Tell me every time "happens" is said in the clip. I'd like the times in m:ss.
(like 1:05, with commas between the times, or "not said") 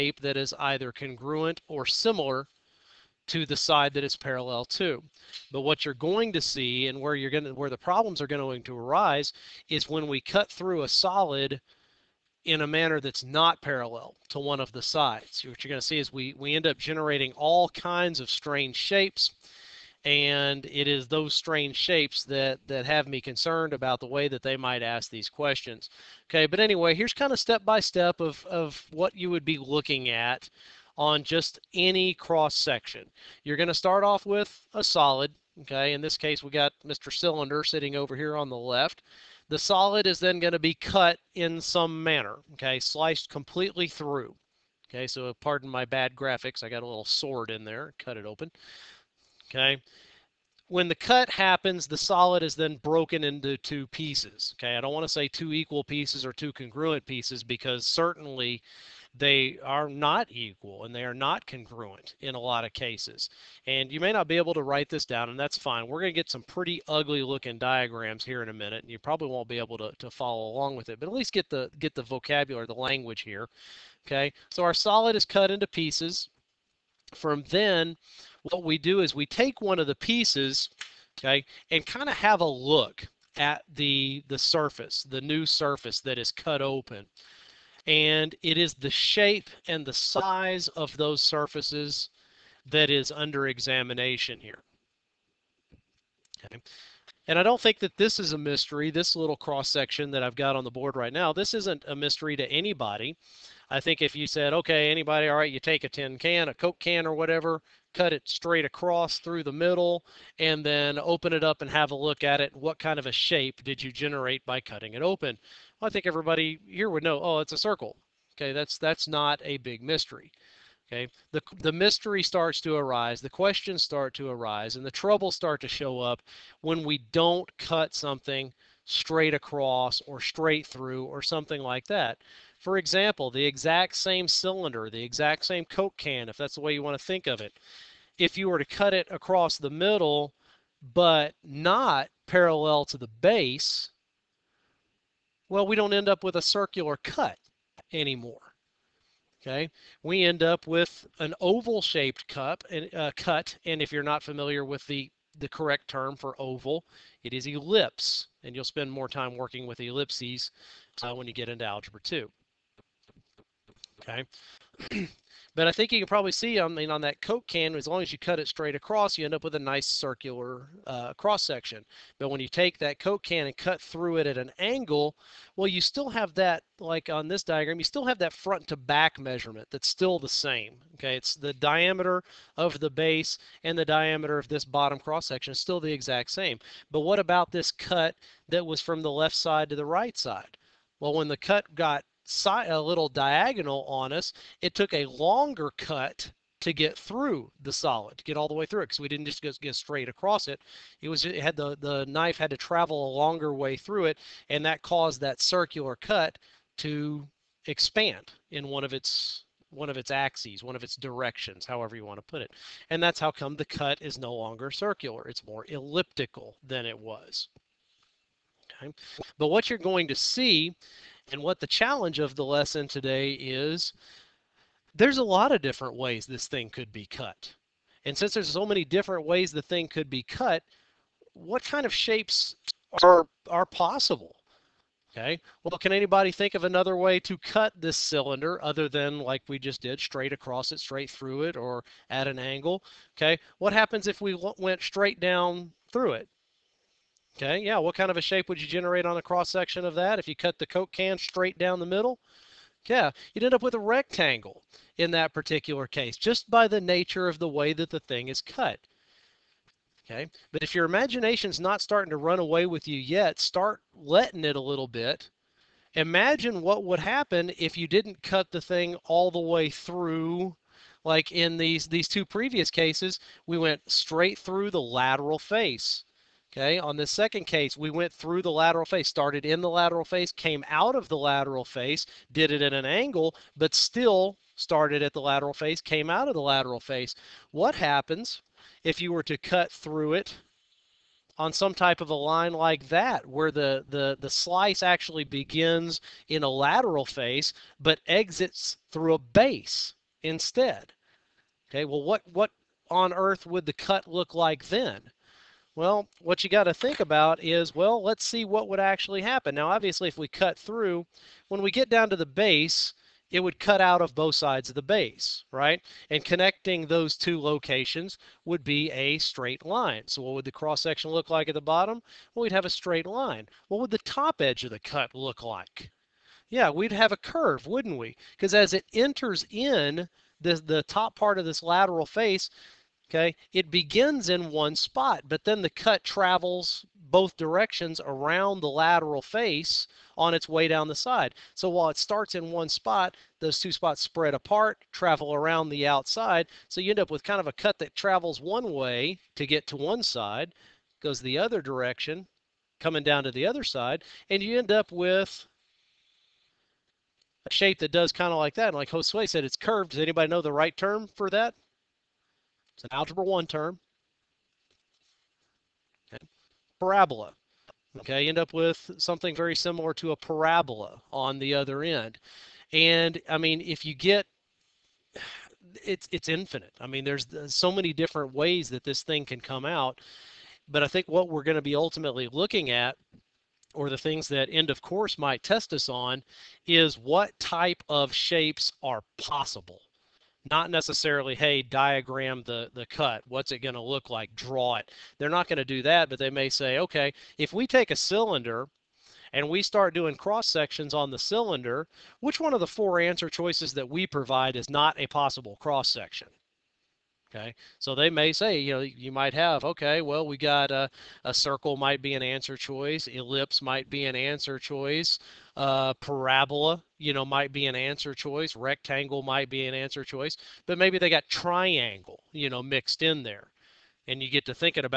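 0:51, 4:03, 4:26, 4:47, 5:09.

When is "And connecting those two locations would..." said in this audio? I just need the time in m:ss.
5:16.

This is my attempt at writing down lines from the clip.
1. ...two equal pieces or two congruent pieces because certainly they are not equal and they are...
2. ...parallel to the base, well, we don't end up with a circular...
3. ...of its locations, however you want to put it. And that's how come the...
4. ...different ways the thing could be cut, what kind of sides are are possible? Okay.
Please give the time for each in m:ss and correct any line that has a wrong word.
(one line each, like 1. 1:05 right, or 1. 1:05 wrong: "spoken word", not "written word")
1. 0:55 right
2. 2:22 right
3. 3:30 wrong: "directions", not "locations"
4. 3:48 wrong: "shapes", not "sides".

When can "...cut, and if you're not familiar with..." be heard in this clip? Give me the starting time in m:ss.
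2:33.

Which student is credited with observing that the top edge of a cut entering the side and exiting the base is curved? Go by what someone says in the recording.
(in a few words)
Josue.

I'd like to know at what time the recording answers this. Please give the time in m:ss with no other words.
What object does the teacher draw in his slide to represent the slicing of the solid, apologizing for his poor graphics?
0:47.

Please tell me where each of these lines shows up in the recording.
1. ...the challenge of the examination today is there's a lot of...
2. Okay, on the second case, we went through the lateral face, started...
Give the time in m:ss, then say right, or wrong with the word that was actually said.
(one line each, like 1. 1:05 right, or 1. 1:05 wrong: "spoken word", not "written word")
1. 3:41 wrong: "lesson", not "examination"
2. 4:36 right.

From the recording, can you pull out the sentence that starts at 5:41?
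So while it starts in one spot, those two spots spread apart, travel around the outside.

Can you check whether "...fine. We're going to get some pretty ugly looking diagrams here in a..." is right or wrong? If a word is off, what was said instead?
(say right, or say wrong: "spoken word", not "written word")
right.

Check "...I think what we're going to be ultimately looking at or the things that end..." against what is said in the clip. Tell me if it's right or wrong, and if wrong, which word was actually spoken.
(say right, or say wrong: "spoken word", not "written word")
right.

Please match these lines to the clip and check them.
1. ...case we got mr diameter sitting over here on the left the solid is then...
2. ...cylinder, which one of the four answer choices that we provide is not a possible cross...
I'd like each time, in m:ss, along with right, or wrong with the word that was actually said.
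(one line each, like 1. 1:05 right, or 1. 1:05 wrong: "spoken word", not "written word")
1. 0:36 wrong: "cylinder", not "diameter"
2. 6:41 right.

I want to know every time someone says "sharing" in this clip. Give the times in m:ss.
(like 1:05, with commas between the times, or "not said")
not said.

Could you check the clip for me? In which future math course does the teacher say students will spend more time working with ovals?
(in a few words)
algebra 2.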